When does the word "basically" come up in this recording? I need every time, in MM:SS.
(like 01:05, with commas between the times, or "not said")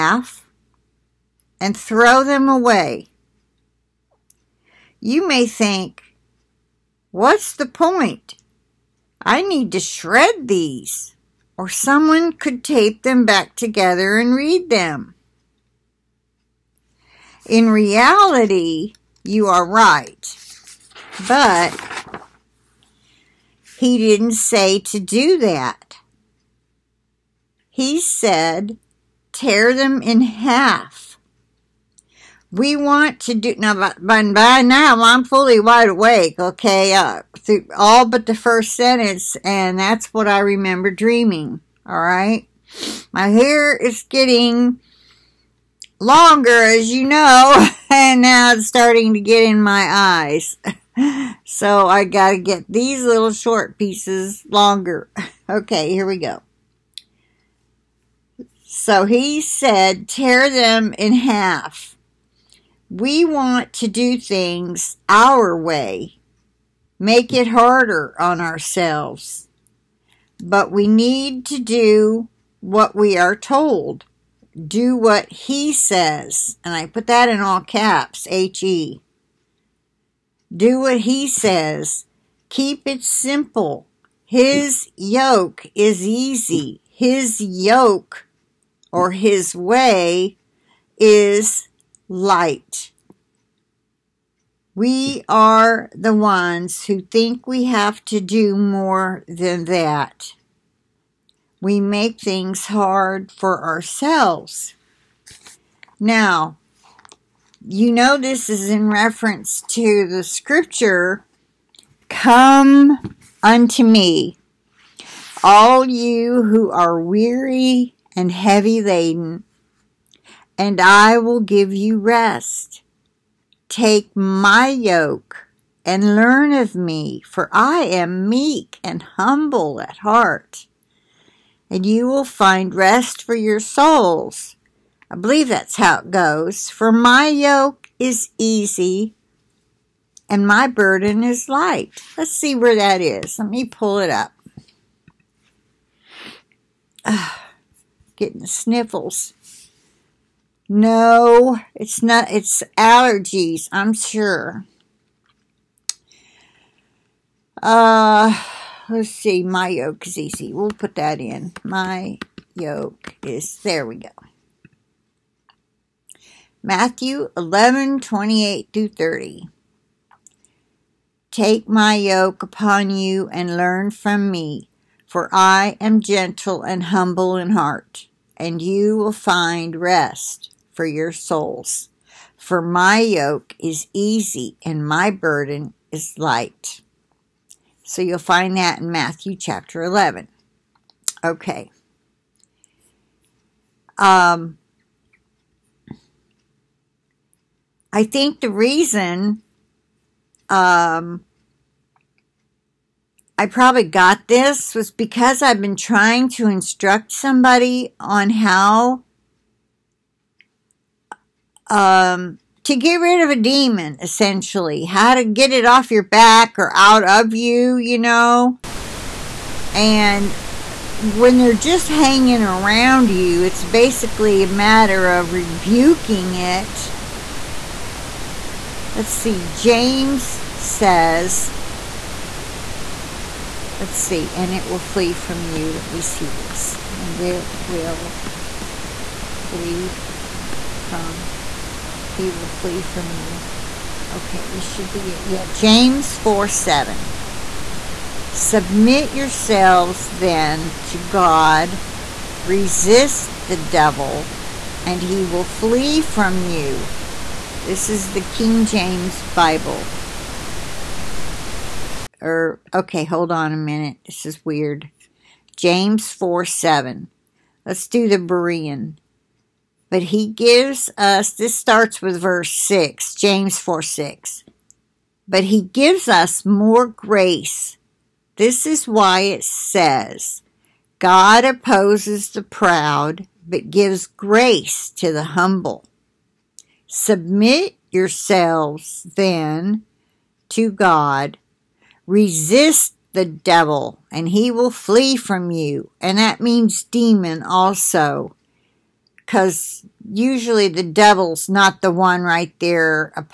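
03:43.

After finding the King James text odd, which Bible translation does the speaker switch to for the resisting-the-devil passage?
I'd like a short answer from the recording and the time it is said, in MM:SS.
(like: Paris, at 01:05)
Berean, at 04:28.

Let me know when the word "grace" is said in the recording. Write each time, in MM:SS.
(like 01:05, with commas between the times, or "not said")
04:36, 04:44.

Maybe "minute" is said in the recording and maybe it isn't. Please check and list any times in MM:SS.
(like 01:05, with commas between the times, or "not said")
04:23.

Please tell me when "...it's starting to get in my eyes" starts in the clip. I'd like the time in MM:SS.
00:48.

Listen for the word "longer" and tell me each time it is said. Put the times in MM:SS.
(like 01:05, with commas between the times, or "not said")
00:45, 00:54.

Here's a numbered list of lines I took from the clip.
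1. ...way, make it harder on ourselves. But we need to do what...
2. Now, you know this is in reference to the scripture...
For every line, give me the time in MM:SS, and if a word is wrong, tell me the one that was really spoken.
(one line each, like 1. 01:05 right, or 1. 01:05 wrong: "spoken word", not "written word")
1. 01:05 right
2. 01:45 right.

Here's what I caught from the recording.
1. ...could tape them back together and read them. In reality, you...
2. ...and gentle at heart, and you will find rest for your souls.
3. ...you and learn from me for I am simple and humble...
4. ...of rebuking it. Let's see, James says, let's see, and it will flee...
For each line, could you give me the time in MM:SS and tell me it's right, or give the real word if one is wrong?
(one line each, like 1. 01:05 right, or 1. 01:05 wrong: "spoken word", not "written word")
1. 00:12 right
2. 02:08 wrong: "humble", not "gentle"
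3. 02:52 wrong: "gentle", not "simple"
4. 03:45 right.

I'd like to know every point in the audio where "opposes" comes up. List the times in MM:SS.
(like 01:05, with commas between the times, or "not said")
04:41.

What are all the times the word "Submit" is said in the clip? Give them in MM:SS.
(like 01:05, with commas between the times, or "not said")
04:08, 04:46.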